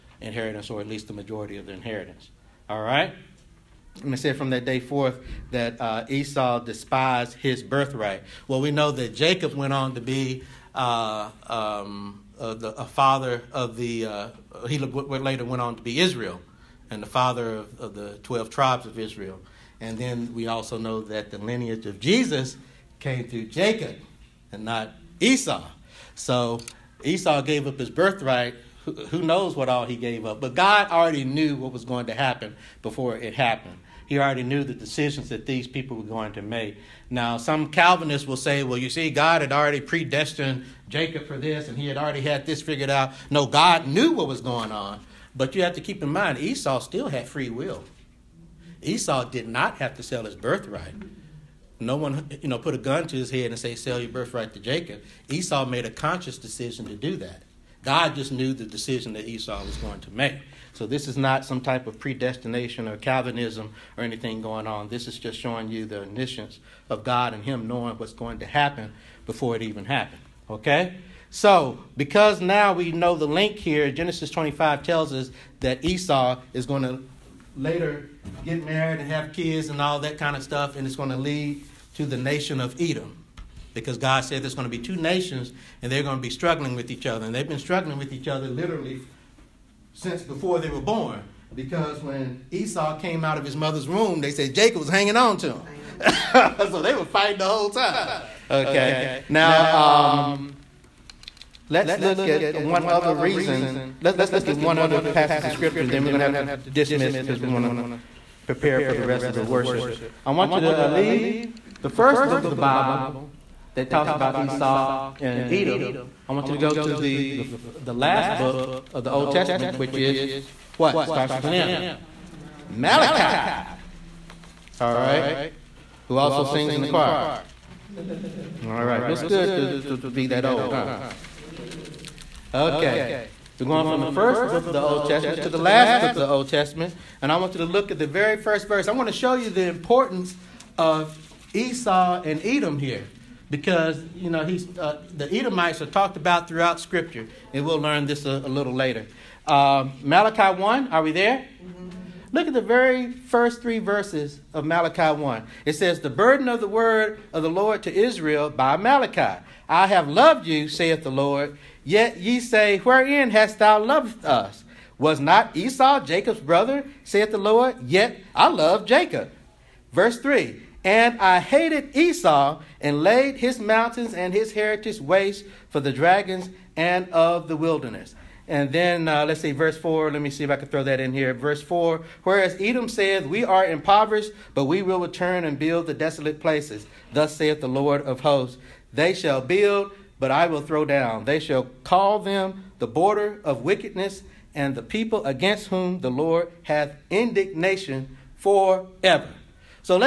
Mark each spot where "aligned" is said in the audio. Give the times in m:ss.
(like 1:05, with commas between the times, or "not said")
not said.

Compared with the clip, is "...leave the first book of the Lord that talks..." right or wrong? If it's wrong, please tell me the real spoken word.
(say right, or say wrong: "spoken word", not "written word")
wrong: "Bible", not "Lord".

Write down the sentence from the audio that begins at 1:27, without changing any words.
And they've been struggling with each other literally since before they were born.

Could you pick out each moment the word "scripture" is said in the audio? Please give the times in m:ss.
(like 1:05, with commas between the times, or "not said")
1:45, 2:26.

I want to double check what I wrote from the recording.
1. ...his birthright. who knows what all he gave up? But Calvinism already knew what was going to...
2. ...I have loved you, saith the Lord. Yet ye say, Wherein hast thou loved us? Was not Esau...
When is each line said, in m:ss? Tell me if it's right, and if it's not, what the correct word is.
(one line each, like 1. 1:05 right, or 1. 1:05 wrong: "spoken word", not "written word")
1. 0:27 wrong: "God", not "Calvinism"
2. 2:39 right.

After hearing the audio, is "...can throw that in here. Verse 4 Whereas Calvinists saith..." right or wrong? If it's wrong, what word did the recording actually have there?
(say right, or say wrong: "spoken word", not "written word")
wrong: "Edom", not "Calvinists".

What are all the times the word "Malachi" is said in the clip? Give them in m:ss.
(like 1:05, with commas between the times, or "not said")
2:02, 2:30, 2:34, 2:38.